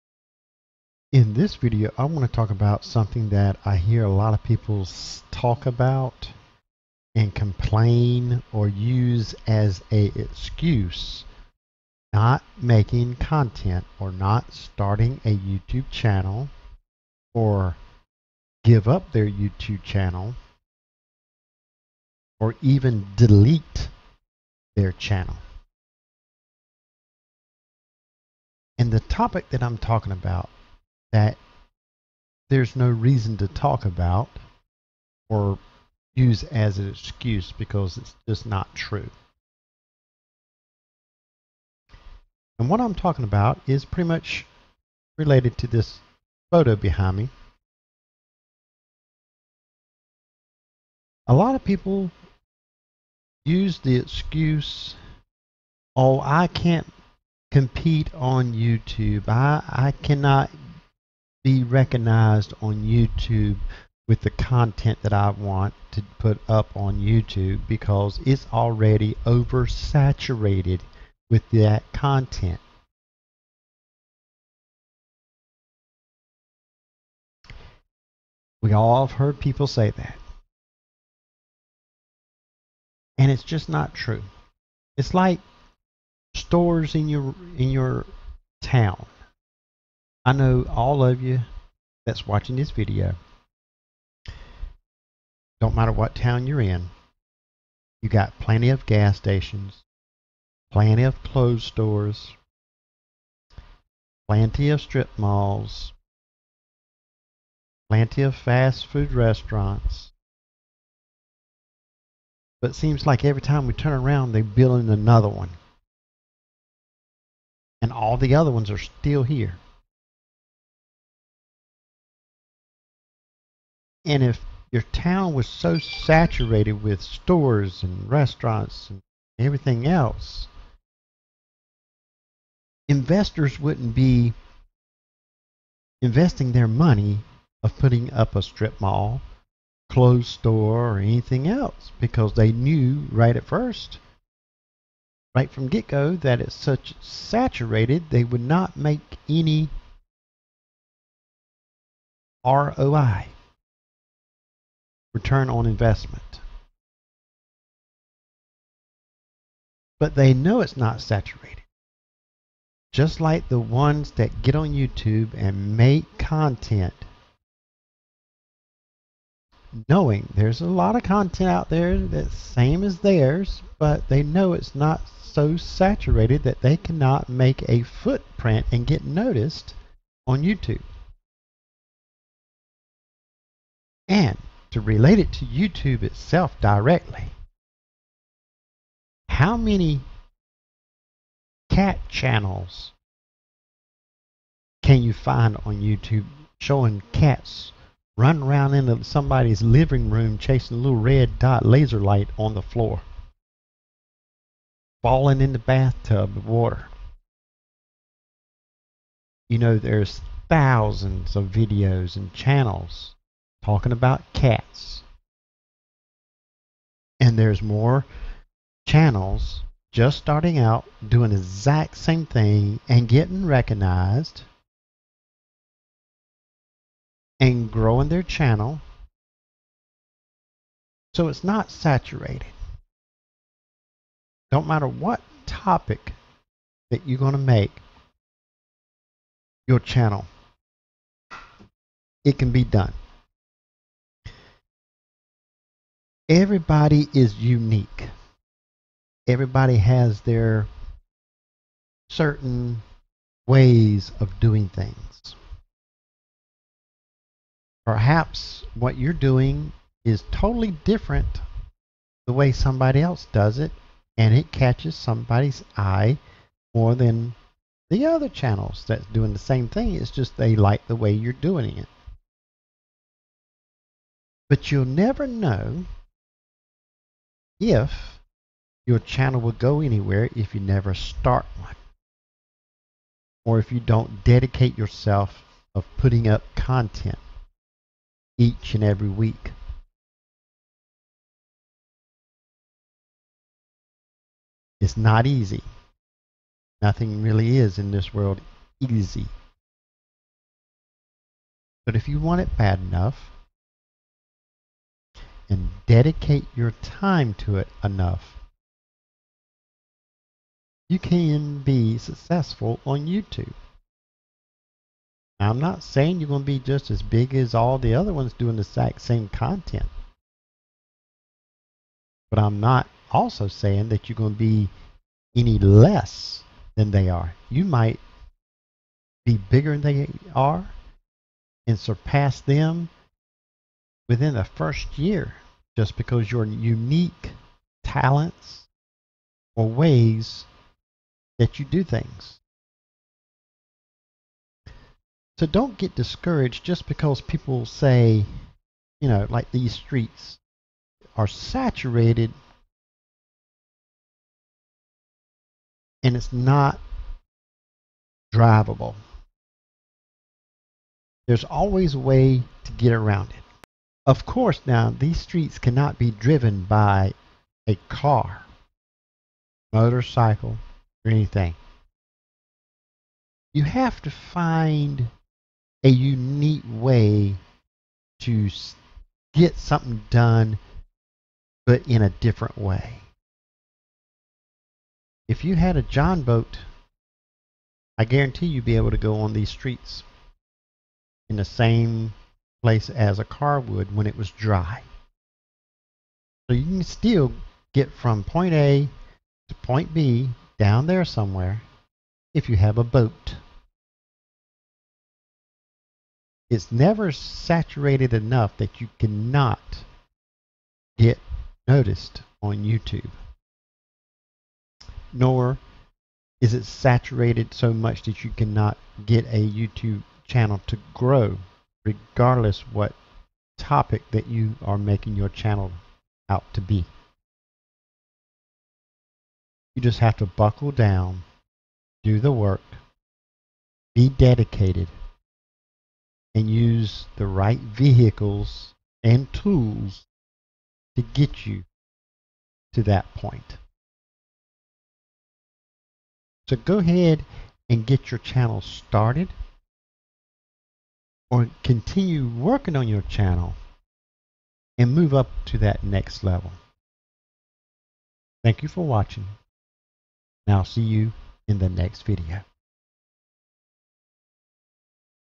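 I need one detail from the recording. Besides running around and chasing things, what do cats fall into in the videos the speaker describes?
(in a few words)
Bathtub of water.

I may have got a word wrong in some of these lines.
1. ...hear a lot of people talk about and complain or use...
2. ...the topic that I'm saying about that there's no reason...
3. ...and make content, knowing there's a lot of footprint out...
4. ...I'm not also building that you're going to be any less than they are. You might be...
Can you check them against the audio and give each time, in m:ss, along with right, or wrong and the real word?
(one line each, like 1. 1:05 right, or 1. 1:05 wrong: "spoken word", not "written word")
1. 0:03 right
2. 0:28 wrong: "talking", not "saying"
3. 2:45 wrong: "content", not "footprint"
4. 5:22 wrong: "saying", not "building".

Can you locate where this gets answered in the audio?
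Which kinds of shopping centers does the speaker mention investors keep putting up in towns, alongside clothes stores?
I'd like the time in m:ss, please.
2:18.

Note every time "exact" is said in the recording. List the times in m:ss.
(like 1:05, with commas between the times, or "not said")
3:41, 5:18.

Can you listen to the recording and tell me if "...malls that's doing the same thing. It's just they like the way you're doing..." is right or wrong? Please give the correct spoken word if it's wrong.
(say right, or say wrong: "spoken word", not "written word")
wrong: "channels", not "malls".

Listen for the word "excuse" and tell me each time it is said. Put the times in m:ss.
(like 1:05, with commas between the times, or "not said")
0:10, 0:36, 0:53.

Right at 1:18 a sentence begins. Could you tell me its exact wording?
We all have heard people say that.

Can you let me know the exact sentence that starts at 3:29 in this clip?
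You know, there's thousands of videos and channels talking about cats.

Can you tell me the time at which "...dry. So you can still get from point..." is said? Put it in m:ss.
6:34.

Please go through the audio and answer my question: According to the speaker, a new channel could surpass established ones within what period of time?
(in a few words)
The first year.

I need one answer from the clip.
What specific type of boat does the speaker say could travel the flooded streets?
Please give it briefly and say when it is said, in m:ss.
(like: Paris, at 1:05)
John boat, at 6:25.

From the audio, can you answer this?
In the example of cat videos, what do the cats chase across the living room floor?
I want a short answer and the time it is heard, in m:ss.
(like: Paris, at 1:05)
Red dot laser light, at 3:20.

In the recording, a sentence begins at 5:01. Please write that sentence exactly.
But if you want it bad enough, and dedicate your time to it enough, you can be successful on YouTube.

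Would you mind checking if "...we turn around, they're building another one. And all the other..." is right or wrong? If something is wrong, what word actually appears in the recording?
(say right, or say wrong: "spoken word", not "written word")
right.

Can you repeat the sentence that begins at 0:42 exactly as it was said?
And what I'm talking about is pretty much related to this photo behind me.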